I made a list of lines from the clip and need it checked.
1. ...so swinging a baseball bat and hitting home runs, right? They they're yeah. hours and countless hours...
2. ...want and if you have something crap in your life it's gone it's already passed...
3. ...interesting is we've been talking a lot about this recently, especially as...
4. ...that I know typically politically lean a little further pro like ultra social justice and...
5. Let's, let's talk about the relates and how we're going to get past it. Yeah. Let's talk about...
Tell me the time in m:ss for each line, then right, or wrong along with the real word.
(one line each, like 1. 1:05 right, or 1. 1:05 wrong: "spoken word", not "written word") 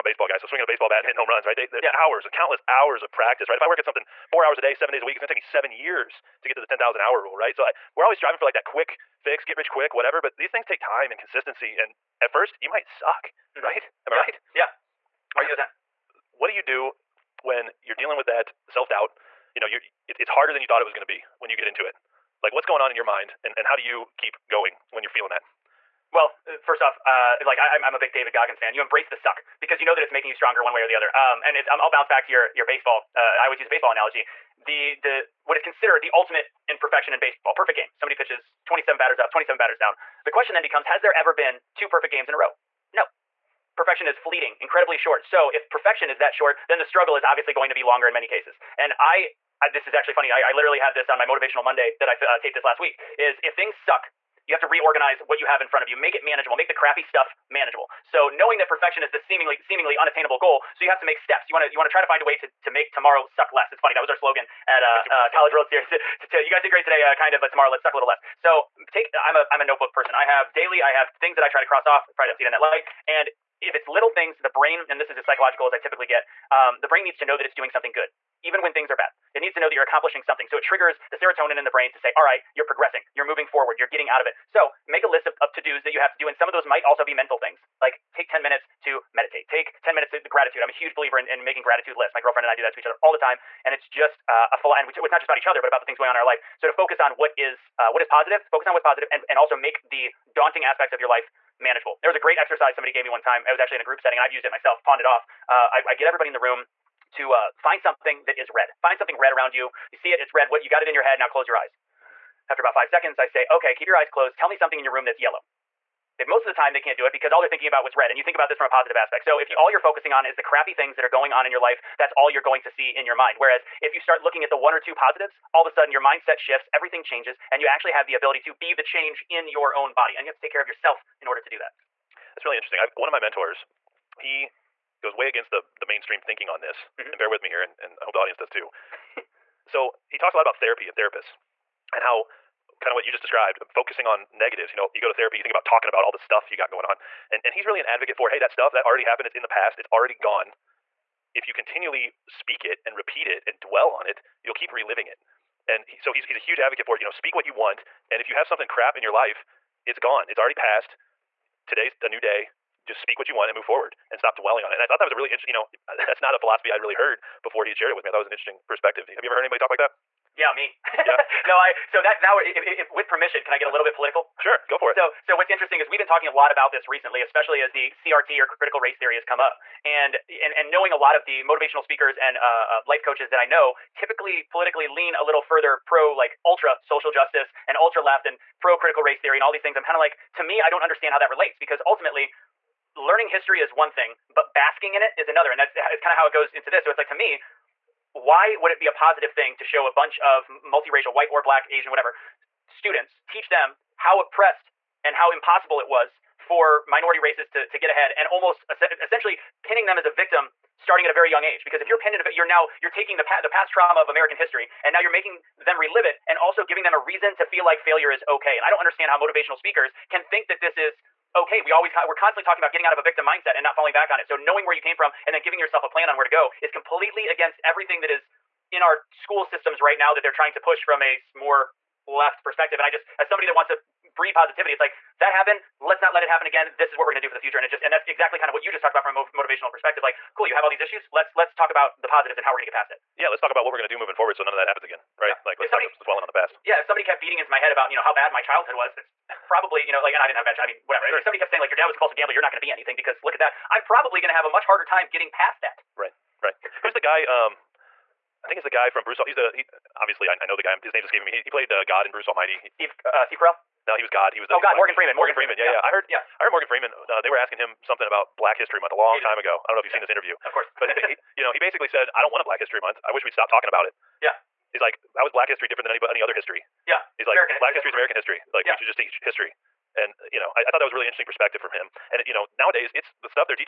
1. 0:00 right
2. 2:37 right
3. 2:55 right
4. 3:03 right
5. 4:01 wrong: "positives", not "relates".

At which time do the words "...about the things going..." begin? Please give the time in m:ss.
1:35.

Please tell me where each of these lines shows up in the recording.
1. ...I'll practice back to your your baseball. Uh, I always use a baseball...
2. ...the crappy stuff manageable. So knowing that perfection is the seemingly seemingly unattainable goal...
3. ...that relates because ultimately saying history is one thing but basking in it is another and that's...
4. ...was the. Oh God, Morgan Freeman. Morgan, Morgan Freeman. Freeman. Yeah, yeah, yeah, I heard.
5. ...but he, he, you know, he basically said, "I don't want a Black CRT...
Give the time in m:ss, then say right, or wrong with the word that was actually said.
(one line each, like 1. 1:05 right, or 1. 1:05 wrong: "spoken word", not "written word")
1. 0:31 wrong: "bounce", not "practice"
2. 0:56 right
3. 3:11 wrong: "learning", not "saying"
4. 4:24 right
5. 4:30 wrong: "History", not "CRT".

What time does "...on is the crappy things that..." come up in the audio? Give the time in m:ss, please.
2:00.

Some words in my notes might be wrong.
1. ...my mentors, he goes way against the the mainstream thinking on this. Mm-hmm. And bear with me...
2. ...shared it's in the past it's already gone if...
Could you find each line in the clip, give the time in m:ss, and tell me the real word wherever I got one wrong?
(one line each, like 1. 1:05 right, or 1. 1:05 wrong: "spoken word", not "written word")
1. 2:13 right
2. 2:29 wrong: "happened", not "shared".